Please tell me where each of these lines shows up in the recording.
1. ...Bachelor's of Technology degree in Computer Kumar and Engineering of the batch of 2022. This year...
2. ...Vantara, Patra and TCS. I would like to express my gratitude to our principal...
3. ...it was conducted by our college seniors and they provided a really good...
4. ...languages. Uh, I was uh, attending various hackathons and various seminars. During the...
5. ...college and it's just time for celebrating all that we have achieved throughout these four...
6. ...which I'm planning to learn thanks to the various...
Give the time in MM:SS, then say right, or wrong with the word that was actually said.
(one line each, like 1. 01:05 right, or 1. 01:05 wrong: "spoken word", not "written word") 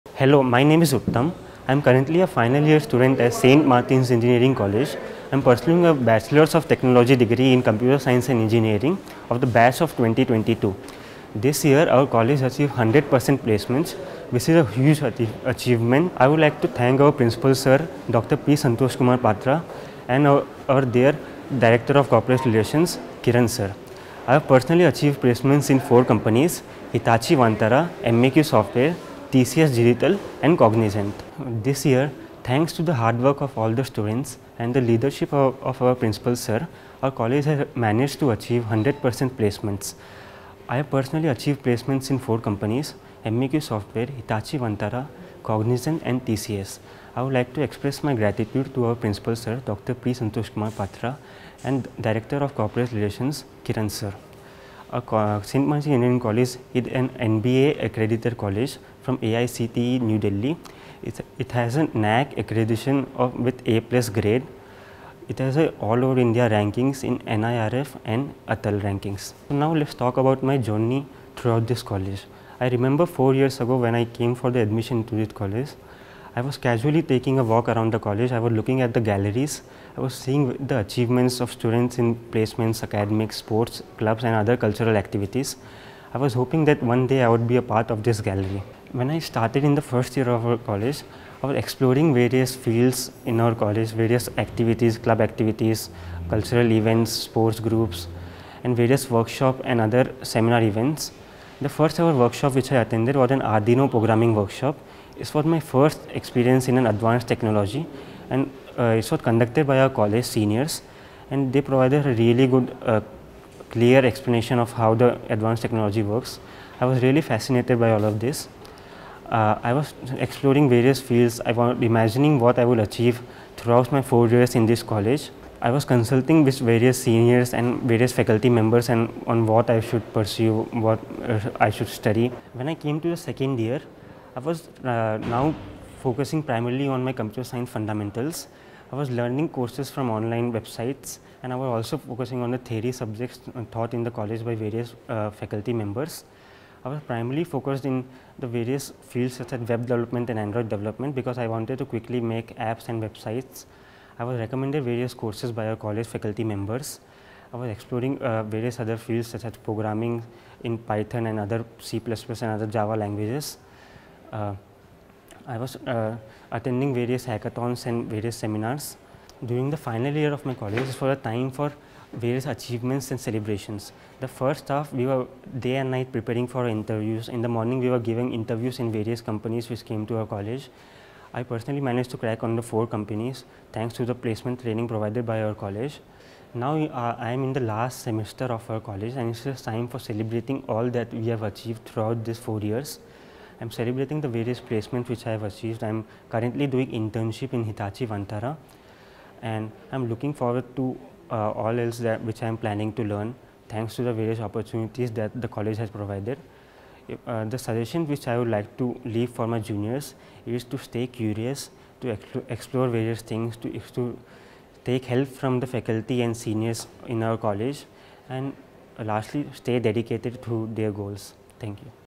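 1. 00:05 wrong: "Science", not "Kumar"
2. 00:44 wrong: "Cognizant", not "Patra"
3. 01:48 right
4. 02:42 right
5. 03:08 right
6. 03:22 right.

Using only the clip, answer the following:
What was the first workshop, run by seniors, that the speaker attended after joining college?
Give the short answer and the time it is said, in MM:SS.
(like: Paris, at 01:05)
Arduino programming workshop, at 01:43.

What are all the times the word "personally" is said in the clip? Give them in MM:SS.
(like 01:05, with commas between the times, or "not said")
00:24, 00:40, 03:01.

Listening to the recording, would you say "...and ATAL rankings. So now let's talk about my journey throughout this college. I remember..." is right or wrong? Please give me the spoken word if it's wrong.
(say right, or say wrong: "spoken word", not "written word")
right.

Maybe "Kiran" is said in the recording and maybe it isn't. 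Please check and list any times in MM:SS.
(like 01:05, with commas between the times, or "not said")
00:23, 00:53.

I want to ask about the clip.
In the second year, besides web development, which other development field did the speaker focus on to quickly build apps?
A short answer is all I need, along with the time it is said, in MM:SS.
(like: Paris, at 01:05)
Android development, at 02:30.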